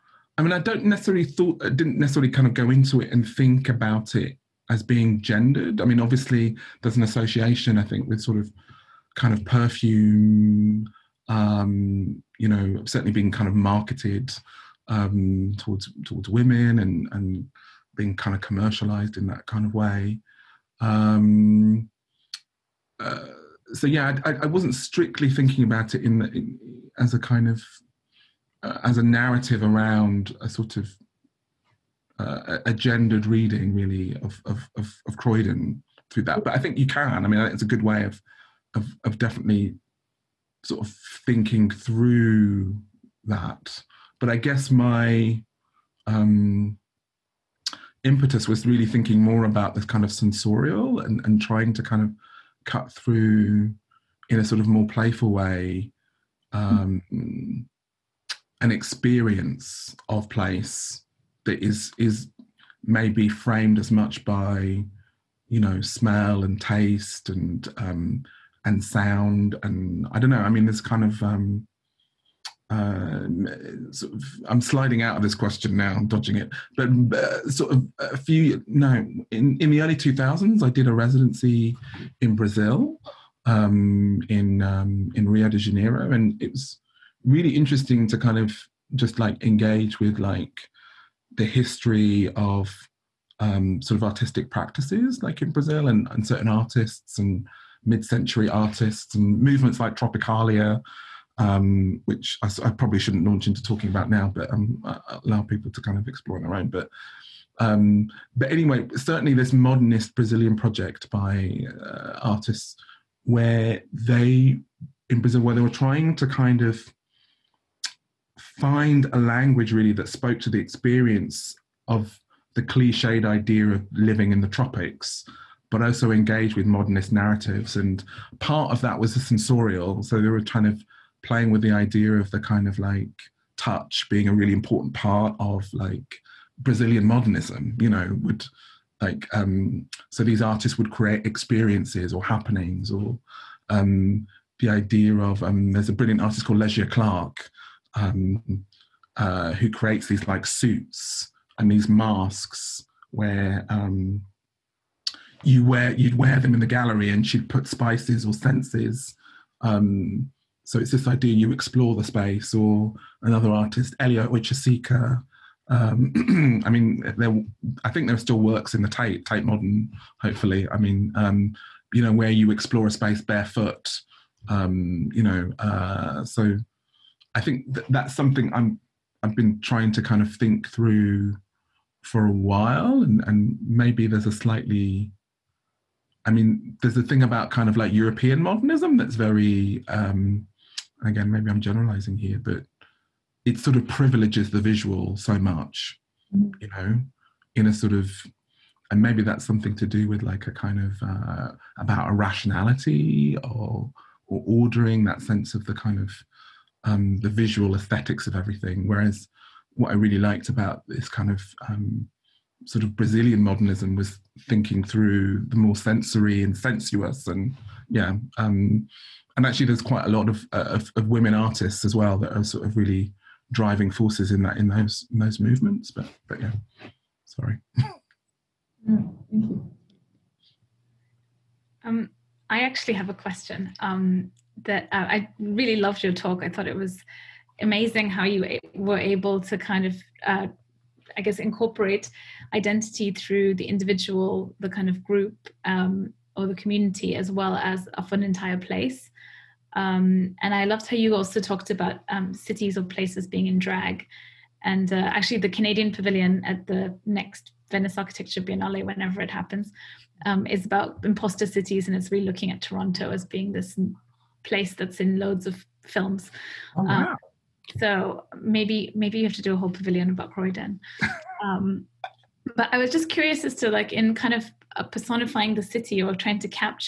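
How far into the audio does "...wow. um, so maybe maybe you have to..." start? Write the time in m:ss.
4:26.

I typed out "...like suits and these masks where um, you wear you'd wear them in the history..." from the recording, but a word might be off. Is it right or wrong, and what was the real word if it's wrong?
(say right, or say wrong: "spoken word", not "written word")
wrong: "gallery", not "history".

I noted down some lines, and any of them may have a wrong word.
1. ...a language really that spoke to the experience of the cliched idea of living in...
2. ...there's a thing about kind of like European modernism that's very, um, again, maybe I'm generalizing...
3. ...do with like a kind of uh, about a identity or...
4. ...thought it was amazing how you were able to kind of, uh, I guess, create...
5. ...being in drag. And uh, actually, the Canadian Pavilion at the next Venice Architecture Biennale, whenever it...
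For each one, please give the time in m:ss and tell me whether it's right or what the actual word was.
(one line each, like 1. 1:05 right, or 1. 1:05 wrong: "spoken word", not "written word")
1. 1:59 right
2. 3:06 right
3. 3:19 wrong: "rationality", not "identity"
4. 3:56 wrong: "incorporate", not "create"
5. 4:13 right.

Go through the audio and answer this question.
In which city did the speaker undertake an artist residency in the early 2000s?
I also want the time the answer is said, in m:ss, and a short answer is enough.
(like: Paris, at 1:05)
Rio de Janeiro, at 1:25.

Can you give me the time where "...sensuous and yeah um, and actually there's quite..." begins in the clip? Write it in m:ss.
3:36.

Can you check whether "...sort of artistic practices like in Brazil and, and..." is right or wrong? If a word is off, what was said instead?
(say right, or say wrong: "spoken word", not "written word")
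right.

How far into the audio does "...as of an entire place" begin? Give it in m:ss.
4:07.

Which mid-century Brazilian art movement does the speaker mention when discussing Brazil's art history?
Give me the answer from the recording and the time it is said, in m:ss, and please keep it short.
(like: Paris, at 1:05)
Tropicalia, at 1:39.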